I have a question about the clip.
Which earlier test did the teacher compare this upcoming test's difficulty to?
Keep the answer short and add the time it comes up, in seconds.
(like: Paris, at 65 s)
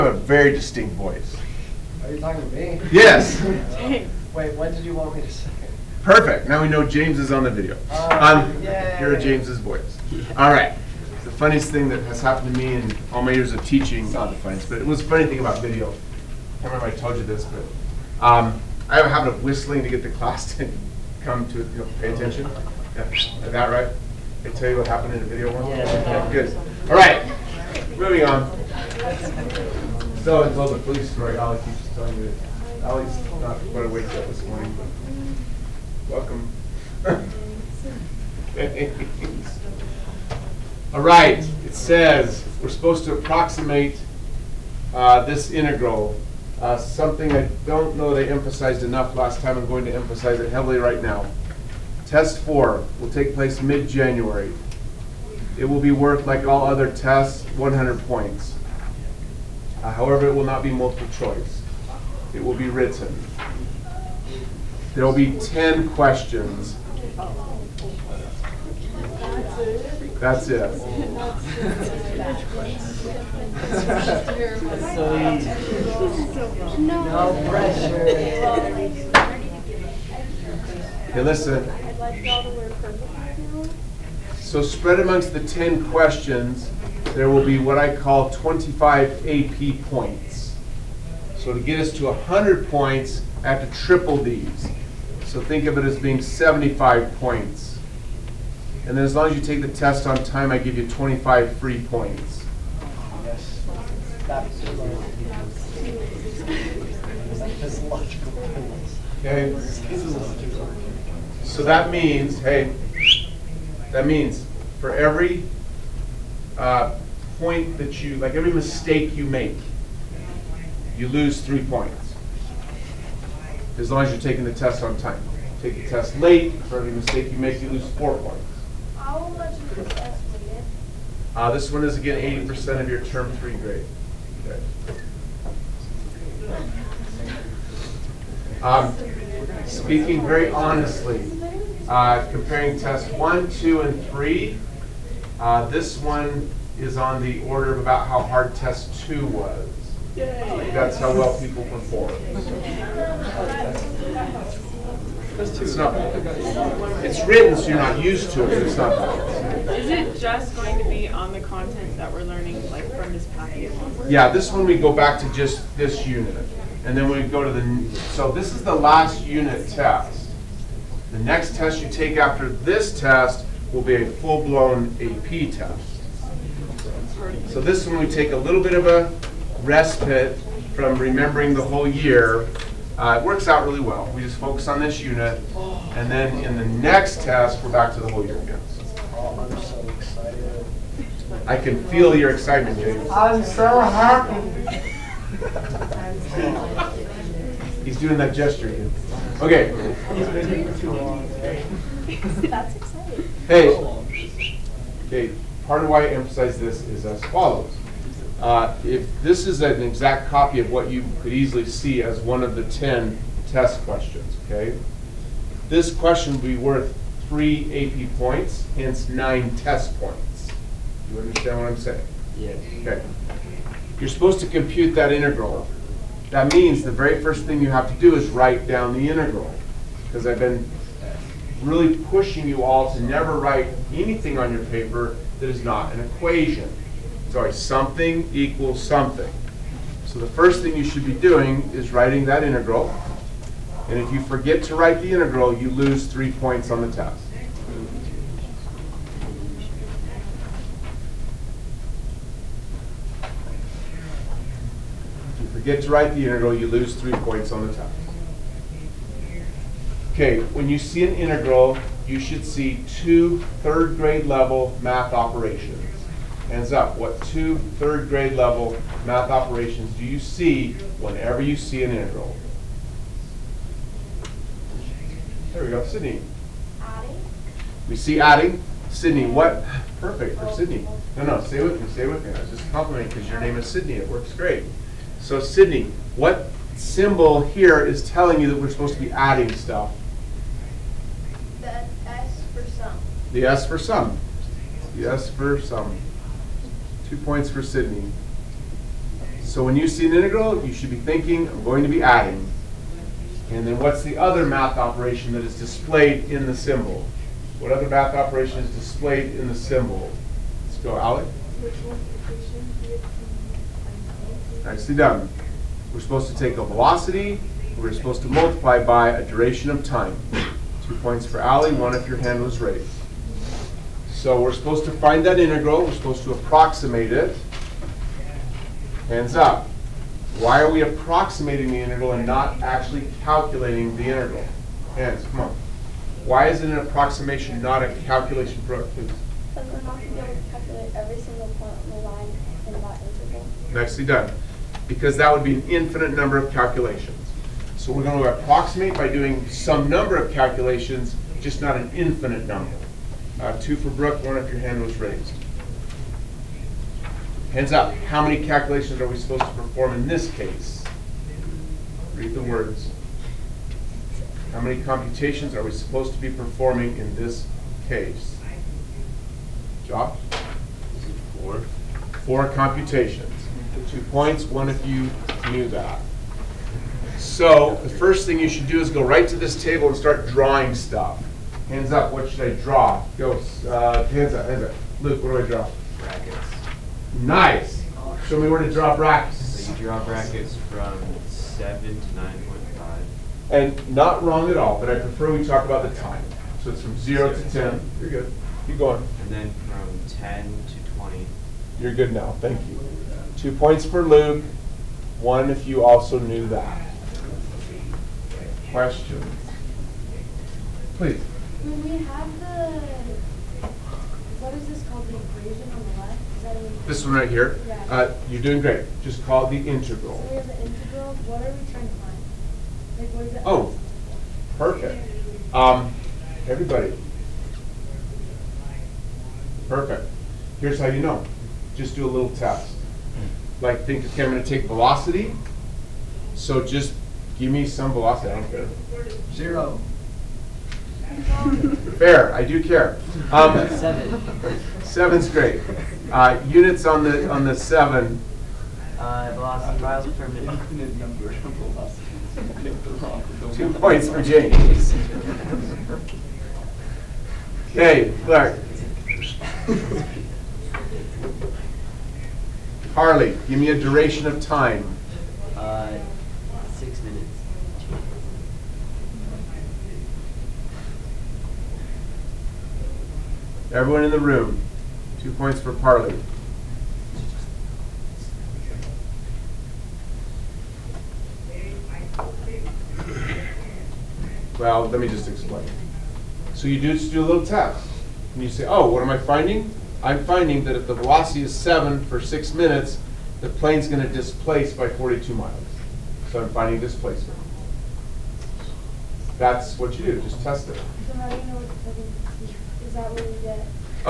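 Test 2, at 148 s.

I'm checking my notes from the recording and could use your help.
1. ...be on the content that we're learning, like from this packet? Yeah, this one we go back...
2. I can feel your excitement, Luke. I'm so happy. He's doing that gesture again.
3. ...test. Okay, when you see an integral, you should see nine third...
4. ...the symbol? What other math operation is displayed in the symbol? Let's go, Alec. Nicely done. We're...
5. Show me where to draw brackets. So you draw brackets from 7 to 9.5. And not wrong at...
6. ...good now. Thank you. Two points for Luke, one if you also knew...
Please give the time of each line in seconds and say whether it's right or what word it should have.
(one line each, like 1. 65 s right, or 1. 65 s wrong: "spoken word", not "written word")
1. 160 s right
2. 191 s wrong: "James", not "Luke"
3. 257 s wrong: "two", not "nine"
4. 306 s right
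5. 388 s right
6. 401 s right.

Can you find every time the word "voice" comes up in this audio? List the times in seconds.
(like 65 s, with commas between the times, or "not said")
0 s, 9 s.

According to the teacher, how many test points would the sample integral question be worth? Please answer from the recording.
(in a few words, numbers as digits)
9.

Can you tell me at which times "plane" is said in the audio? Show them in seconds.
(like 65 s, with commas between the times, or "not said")
493 s.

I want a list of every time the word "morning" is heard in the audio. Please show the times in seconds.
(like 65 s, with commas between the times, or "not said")
34 s.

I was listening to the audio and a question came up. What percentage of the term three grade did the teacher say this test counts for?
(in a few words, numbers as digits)
80 percent.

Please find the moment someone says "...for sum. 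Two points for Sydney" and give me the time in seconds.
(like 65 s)
295 s.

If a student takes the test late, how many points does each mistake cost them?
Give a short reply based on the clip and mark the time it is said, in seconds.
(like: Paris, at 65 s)
4, at 127 s.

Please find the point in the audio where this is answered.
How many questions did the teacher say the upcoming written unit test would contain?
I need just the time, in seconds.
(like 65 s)
64 s.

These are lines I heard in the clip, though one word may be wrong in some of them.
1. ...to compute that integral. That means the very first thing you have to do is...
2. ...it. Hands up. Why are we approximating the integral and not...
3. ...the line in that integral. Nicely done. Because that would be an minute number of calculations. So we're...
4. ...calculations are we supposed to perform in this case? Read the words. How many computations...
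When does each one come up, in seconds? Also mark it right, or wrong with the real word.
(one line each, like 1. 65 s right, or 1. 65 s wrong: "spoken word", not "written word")
1. 224 s right
2. 327 s right
3. 341 s wrong: "infinite", not "minute"
4. 358 s right.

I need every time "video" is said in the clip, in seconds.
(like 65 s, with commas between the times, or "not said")
7 s, 15 s, 25 s.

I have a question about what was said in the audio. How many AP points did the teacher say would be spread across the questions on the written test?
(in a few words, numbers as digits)
25.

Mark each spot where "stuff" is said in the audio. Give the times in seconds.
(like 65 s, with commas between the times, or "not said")
289 s, 380 s.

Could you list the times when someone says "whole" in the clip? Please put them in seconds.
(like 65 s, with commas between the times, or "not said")
181 s, 188 s.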